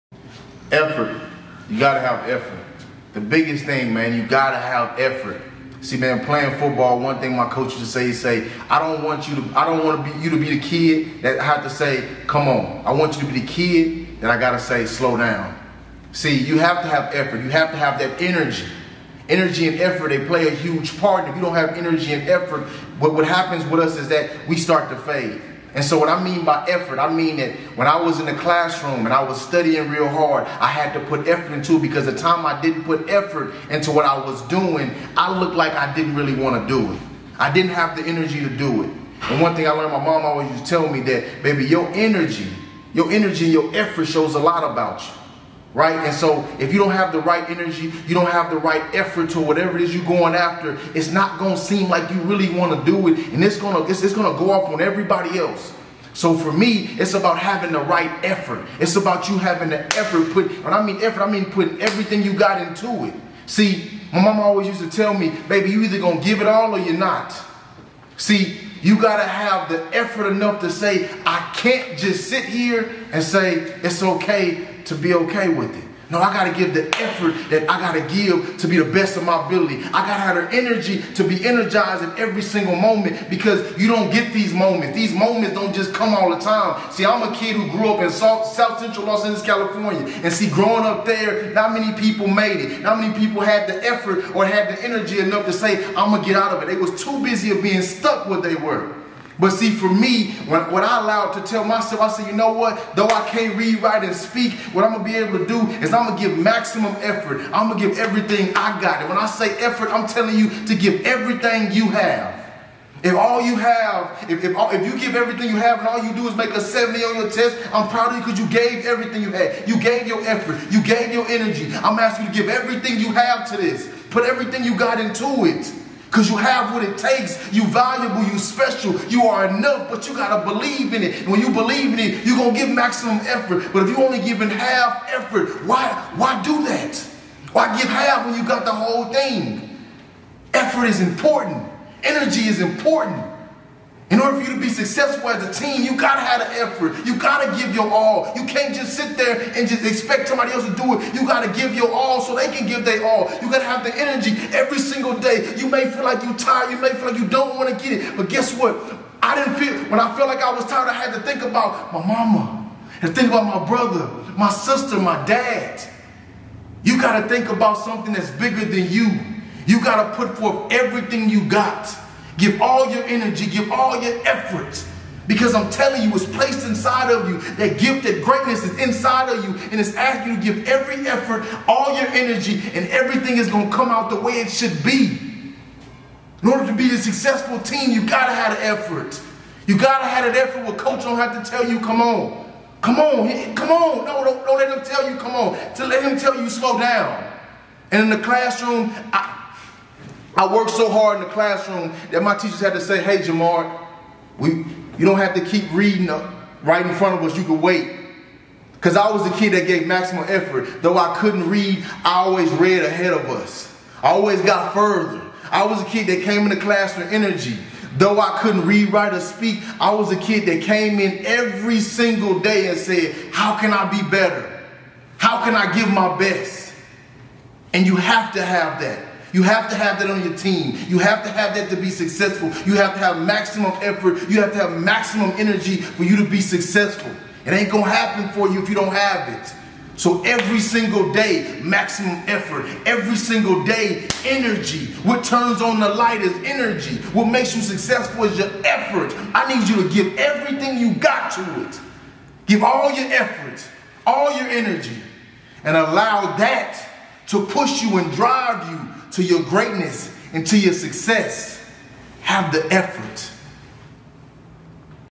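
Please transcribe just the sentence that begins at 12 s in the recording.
I want you to be the kid that I gotta say, slow down.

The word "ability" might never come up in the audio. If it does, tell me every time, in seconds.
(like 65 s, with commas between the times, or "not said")
79 s.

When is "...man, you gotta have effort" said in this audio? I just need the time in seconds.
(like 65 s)
3 s.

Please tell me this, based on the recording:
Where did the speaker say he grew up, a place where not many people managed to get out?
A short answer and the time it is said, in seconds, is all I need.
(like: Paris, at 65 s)
South Central Los Angeles, at 88 s.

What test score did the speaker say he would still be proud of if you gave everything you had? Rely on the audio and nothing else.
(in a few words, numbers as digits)
70.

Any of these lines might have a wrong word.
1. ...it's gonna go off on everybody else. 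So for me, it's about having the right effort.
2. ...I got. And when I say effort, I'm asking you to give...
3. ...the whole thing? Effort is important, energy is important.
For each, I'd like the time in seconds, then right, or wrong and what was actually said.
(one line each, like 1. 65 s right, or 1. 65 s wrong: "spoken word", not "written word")
1. 54 s right
2. 108 s wrong: "telling", not "asking"
3. 138 s right.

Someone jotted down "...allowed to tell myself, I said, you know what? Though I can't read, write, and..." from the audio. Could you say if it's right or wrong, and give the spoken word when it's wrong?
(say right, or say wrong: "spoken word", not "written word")
right.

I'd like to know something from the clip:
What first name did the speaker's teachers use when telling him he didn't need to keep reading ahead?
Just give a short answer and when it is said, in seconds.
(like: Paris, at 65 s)
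Jamar, at 203 s.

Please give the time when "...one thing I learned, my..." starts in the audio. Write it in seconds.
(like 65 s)
39 s.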